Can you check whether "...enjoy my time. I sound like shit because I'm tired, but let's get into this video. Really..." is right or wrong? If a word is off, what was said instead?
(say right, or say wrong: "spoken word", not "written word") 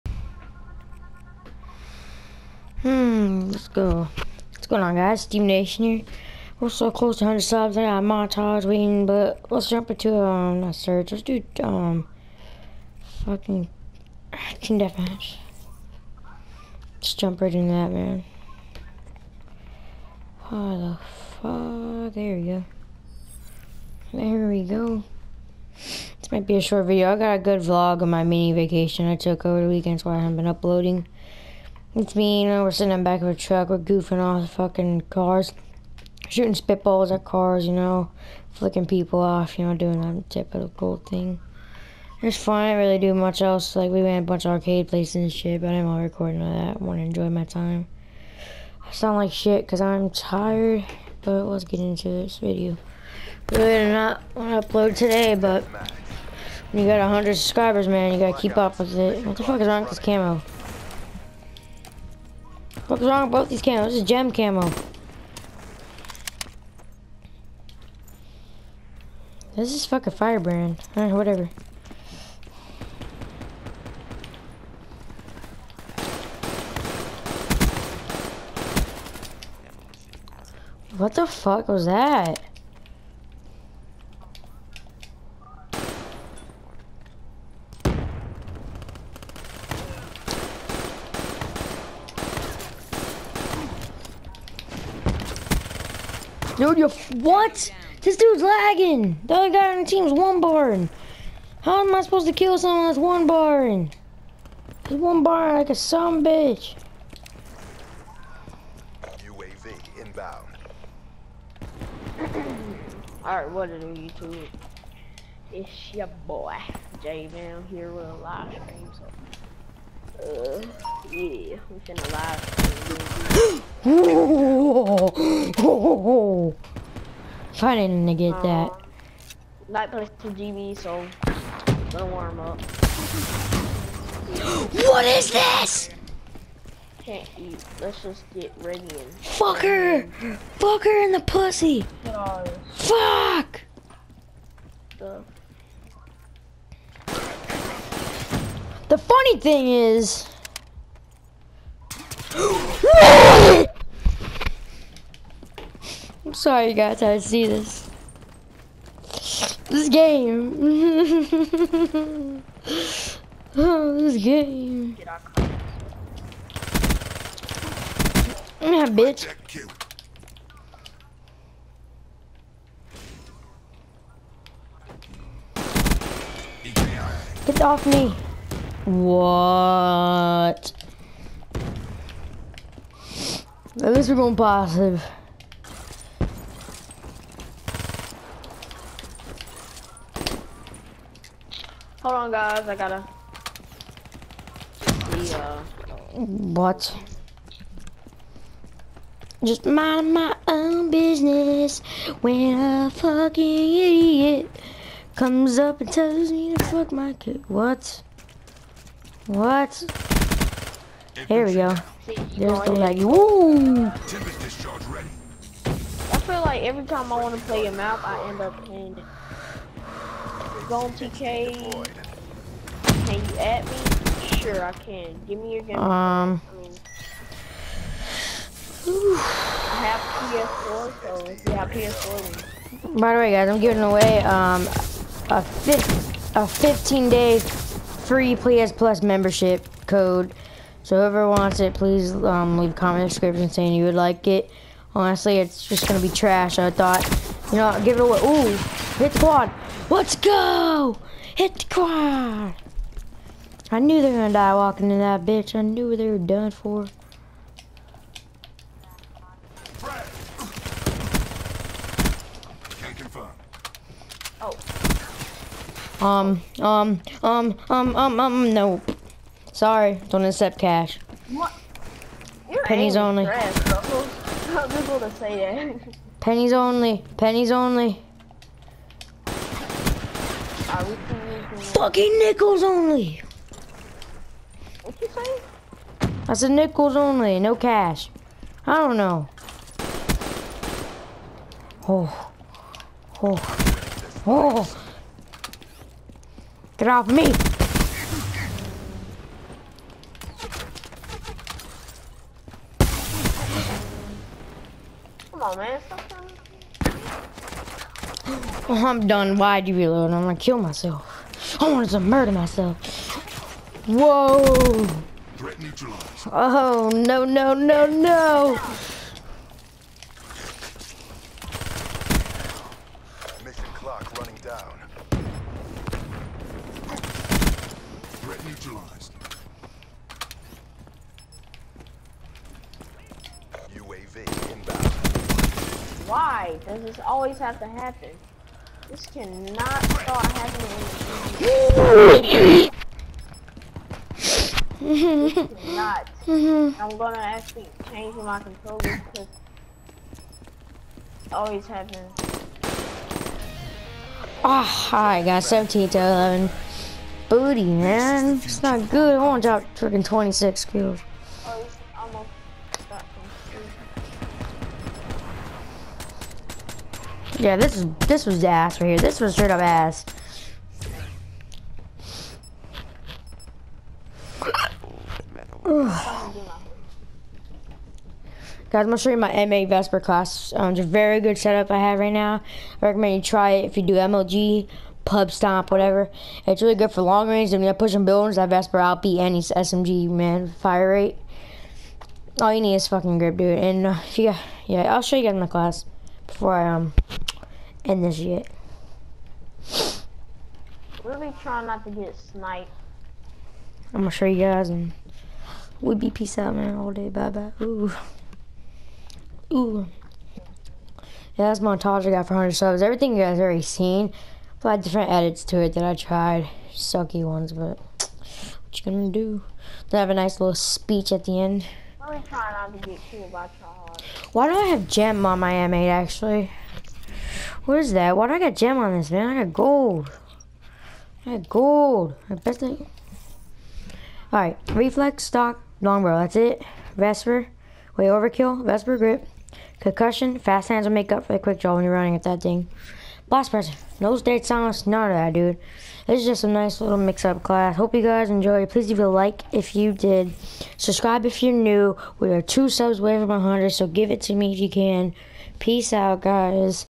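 right.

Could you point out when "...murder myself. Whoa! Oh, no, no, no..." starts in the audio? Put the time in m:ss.
5:11.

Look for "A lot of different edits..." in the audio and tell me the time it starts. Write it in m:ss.
6:54.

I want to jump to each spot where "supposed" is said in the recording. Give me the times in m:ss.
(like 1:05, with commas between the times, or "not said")
1:42.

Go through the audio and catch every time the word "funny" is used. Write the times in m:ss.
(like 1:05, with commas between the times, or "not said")
2:29.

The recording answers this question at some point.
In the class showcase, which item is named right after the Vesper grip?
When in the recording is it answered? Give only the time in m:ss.
7:19.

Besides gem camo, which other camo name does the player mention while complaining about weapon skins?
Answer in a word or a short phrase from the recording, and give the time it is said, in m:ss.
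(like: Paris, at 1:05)
Firebrand, at 1:10.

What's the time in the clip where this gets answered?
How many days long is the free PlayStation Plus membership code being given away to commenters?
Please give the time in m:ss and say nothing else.
3:56.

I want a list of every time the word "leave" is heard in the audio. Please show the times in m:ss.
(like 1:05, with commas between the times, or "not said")
4:02, 7:28.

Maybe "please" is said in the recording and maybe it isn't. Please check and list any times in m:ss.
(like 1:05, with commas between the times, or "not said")
4:01, 7:28.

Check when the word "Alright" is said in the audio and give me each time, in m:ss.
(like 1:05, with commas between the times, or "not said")
1:53, 7:14.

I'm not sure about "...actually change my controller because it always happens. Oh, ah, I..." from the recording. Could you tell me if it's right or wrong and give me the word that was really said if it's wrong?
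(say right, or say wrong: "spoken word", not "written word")
right.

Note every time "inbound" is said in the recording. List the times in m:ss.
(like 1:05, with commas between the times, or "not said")
1:50, 5:34.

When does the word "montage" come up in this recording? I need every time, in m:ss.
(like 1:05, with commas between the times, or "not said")
0:08, 6:51.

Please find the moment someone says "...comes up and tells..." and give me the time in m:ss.
3:25.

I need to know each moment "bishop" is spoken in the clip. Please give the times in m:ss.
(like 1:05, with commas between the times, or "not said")
not said.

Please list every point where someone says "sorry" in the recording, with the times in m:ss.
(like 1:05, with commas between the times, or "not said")
2:36, 4:29.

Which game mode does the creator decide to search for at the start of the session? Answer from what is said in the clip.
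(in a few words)
Team Deathmatch.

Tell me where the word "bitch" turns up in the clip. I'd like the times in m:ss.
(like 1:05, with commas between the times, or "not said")
1:46, 2:48, 4:15.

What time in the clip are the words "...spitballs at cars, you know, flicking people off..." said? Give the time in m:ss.
0:36.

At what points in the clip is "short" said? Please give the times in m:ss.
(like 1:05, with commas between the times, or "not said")
0:26.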